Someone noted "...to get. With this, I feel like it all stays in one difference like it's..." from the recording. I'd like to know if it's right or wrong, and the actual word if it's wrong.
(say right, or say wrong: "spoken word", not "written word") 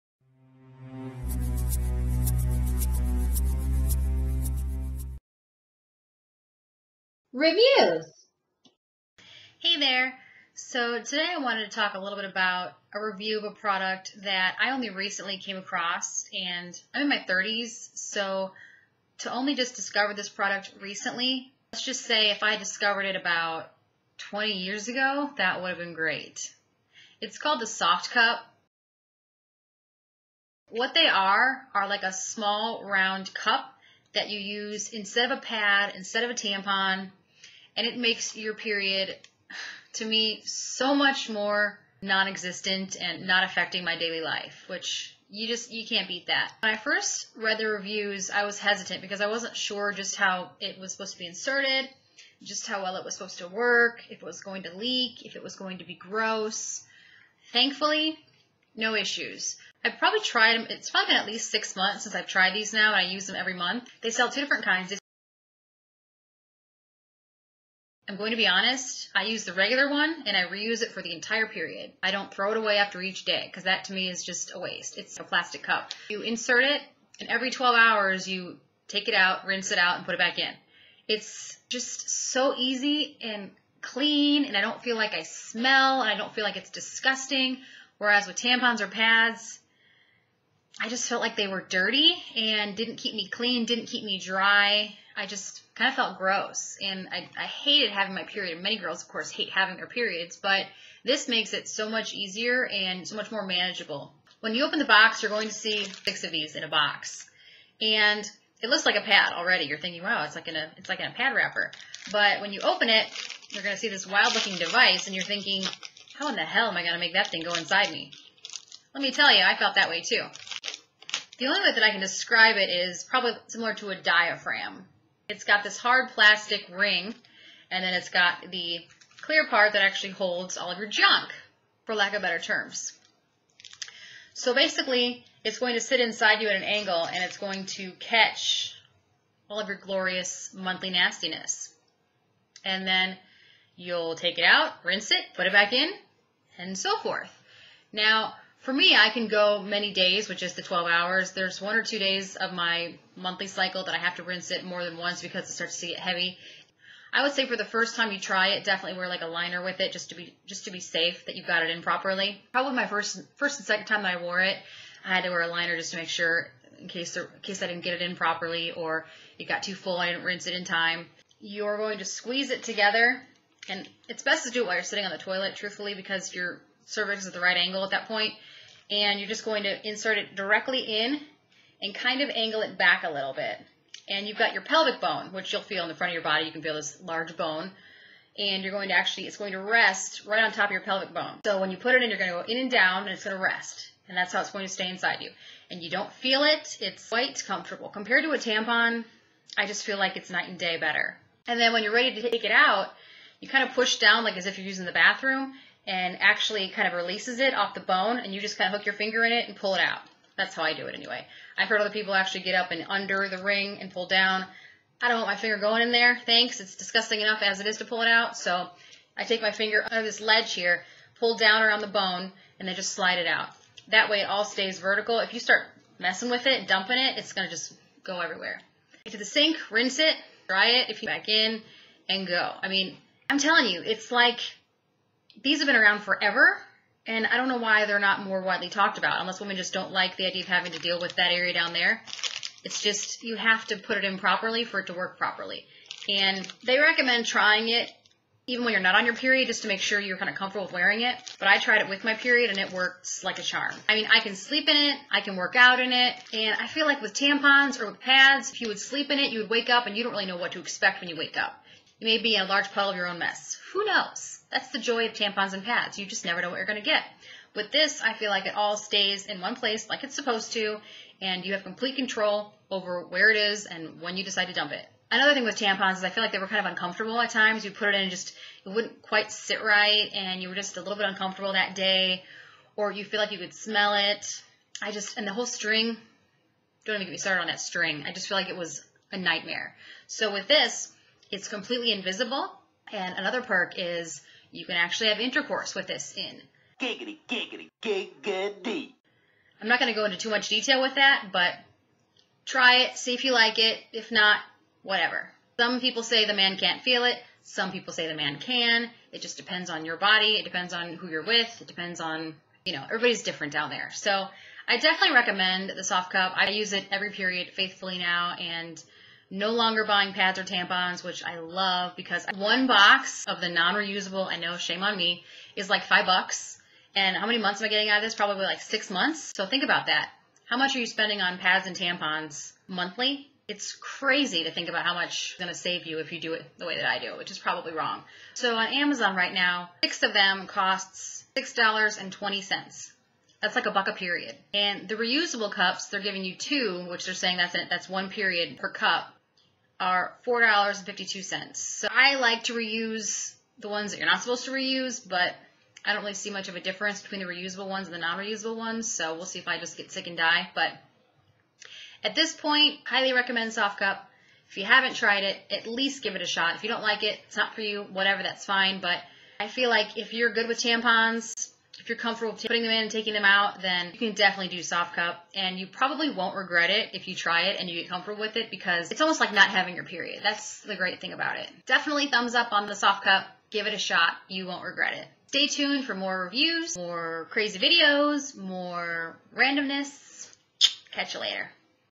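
wrong: "place", not "difference".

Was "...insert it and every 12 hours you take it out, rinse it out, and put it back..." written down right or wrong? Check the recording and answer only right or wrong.
right.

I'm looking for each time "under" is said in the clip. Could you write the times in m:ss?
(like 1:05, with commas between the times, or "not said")
3:32, 3:39.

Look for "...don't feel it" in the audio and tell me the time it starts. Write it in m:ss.
3:15.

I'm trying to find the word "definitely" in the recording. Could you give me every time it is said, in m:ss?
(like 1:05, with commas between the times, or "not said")
2:38, 5:14, 6:14, 6:21.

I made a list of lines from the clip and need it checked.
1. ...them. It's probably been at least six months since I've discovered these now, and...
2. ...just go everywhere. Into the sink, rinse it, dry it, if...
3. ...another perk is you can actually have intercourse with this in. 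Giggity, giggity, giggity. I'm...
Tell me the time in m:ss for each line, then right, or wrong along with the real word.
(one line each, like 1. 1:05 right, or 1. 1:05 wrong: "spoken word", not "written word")
1. 1:00 wrong: "tried", not "discovered"
2. 3:47 right
3. 4:53 right.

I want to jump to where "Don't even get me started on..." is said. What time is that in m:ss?
4:46.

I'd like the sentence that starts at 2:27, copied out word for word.
Now, for me, I can go many days, which is the 12 hours.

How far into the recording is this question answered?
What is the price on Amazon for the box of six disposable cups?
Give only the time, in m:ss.
5:41.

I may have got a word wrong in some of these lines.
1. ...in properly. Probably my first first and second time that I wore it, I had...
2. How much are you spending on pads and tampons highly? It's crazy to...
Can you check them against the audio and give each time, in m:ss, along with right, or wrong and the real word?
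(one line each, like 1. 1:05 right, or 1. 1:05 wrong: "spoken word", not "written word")
1. 2:41 right
2. 5:30 wrong: "monthly", not "highly".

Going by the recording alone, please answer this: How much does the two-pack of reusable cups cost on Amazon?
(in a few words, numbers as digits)
$4.52.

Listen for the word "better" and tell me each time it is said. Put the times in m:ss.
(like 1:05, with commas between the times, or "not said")
2:12, 3:20.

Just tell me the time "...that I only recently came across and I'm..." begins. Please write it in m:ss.
0:14.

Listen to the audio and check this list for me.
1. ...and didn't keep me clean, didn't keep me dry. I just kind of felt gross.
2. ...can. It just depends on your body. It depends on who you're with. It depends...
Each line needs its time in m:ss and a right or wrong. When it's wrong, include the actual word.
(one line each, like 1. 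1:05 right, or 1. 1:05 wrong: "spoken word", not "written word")
1. 1:32 right
2. 5:08 right.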